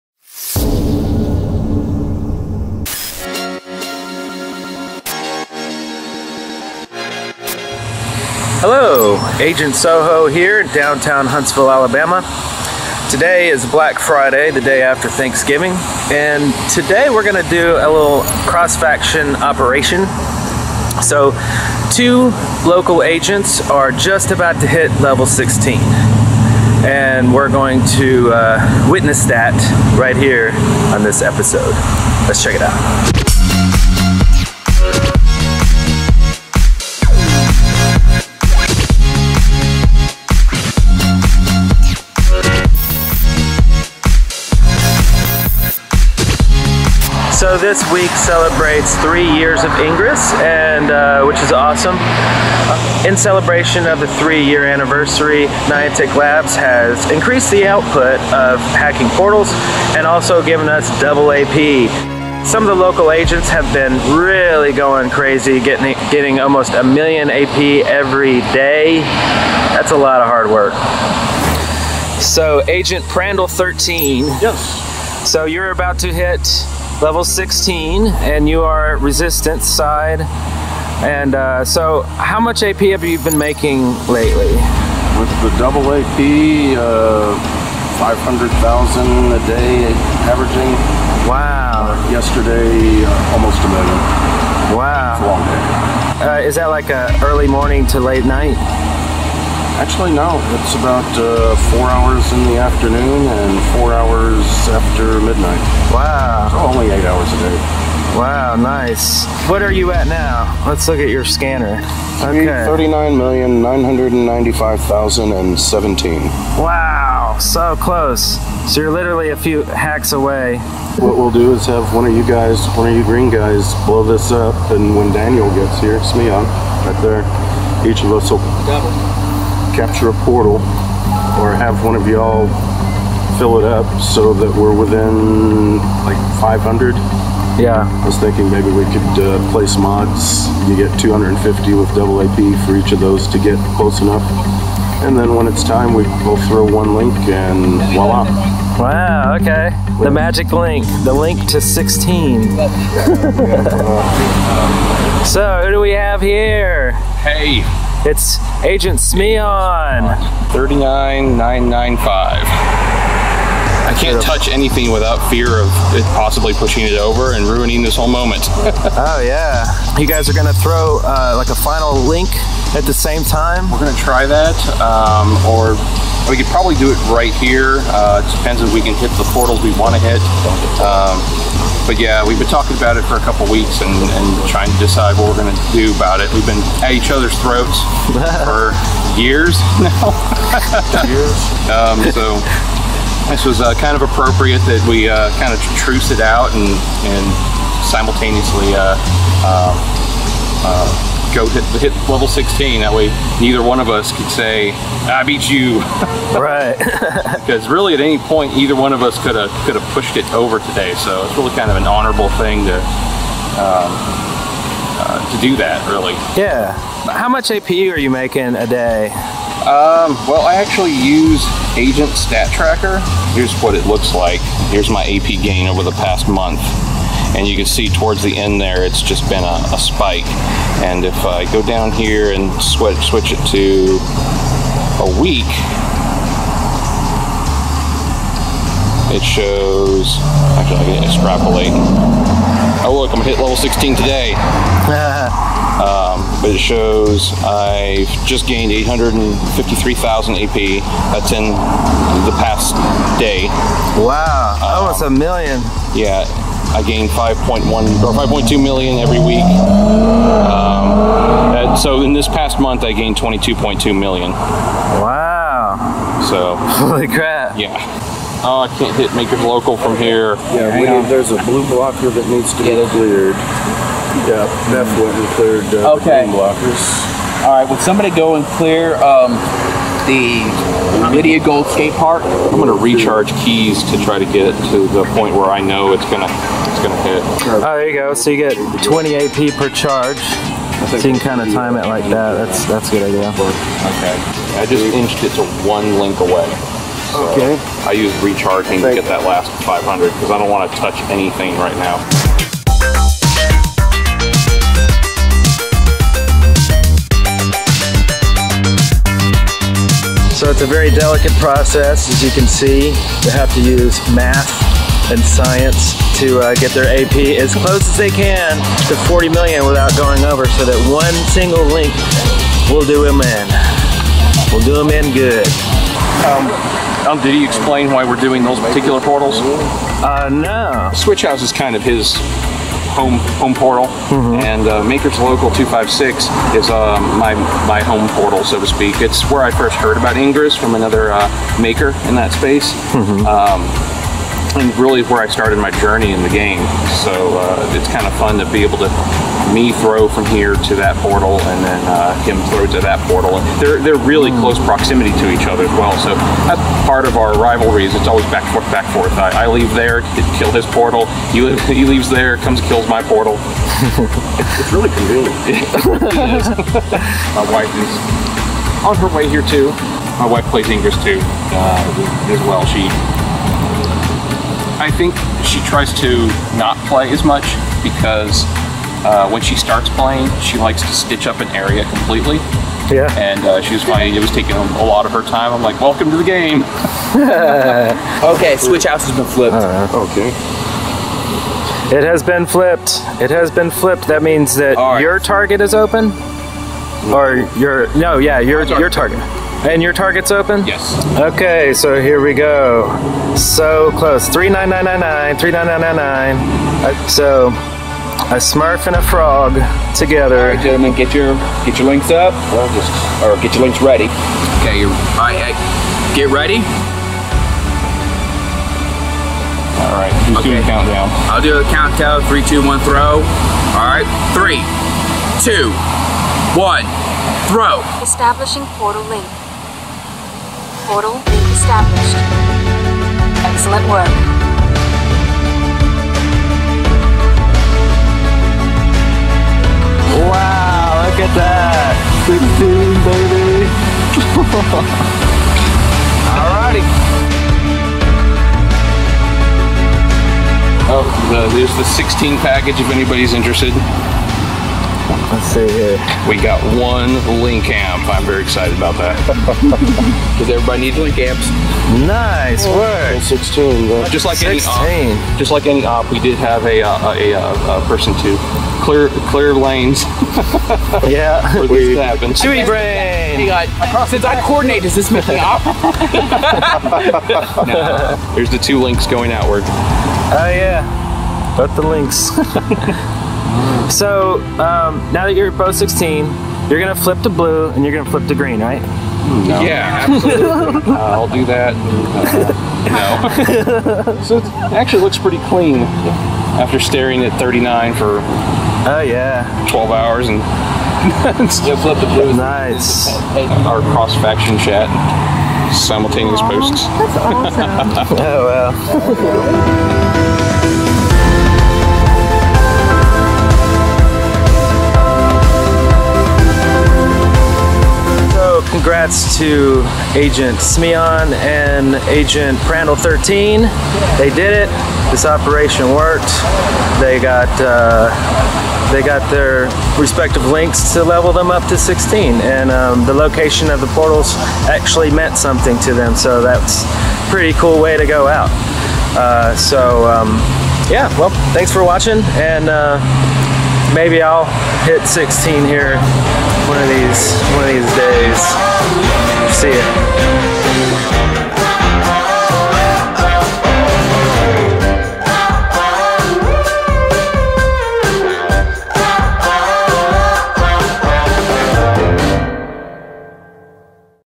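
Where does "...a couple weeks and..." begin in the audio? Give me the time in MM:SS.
03:03.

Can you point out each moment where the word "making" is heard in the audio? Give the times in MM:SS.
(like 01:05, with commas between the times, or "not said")
01:23, 03:38.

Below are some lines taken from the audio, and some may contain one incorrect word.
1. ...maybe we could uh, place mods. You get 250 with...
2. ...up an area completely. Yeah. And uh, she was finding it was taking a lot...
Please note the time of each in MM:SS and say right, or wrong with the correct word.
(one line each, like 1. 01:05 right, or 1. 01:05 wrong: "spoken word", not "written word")
1. 02:18 right
2. 06:21 right.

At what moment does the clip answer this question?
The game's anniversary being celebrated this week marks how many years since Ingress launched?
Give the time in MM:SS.
00:48.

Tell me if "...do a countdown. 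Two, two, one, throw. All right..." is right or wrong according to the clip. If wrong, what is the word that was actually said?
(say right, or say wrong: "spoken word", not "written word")
wrong: "Three", not "Two".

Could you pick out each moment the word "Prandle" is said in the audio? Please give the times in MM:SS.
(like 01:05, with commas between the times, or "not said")
01:13, 08:42.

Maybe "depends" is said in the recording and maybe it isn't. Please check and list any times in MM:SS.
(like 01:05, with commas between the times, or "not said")
02:58.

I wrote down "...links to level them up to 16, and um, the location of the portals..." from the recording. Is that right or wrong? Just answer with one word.
right.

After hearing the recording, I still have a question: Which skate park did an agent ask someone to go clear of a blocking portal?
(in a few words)
Lydia Gold skate park.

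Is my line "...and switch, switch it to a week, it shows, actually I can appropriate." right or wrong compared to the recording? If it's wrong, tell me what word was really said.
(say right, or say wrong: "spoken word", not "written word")
wrong: "extrapolate", not "appropriate".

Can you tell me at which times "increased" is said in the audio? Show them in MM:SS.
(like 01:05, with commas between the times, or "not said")
00:57.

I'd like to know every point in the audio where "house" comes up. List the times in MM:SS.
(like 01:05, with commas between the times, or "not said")
05:31, 06:28.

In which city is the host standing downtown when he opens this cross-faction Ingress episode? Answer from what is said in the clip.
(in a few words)
Huntsville, Alabama.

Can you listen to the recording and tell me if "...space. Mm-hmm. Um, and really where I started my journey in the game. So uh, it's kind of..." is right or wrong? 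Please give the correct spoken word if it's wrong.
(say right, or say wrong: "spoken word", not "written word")
right.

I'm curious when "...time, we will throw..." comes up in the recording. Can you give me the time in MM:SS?
02:25.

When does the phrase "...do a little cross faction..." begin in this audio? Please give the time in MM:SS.
00:17.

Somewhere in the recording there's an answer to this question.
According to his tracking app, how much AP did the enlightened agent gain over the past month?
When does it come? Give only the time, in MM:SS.
04:23.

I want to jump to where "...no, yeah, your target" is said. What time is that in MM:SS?
06:37.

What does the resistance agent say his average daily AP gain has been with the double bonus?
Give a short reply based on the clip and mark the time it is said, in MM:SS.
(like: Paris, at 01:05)
500,000, at 01:27.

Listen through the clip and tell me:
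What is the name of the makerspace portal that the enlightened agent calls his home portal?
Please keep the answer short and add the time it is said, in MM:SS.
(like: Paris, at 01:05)
Makers Local 256, at 05:34.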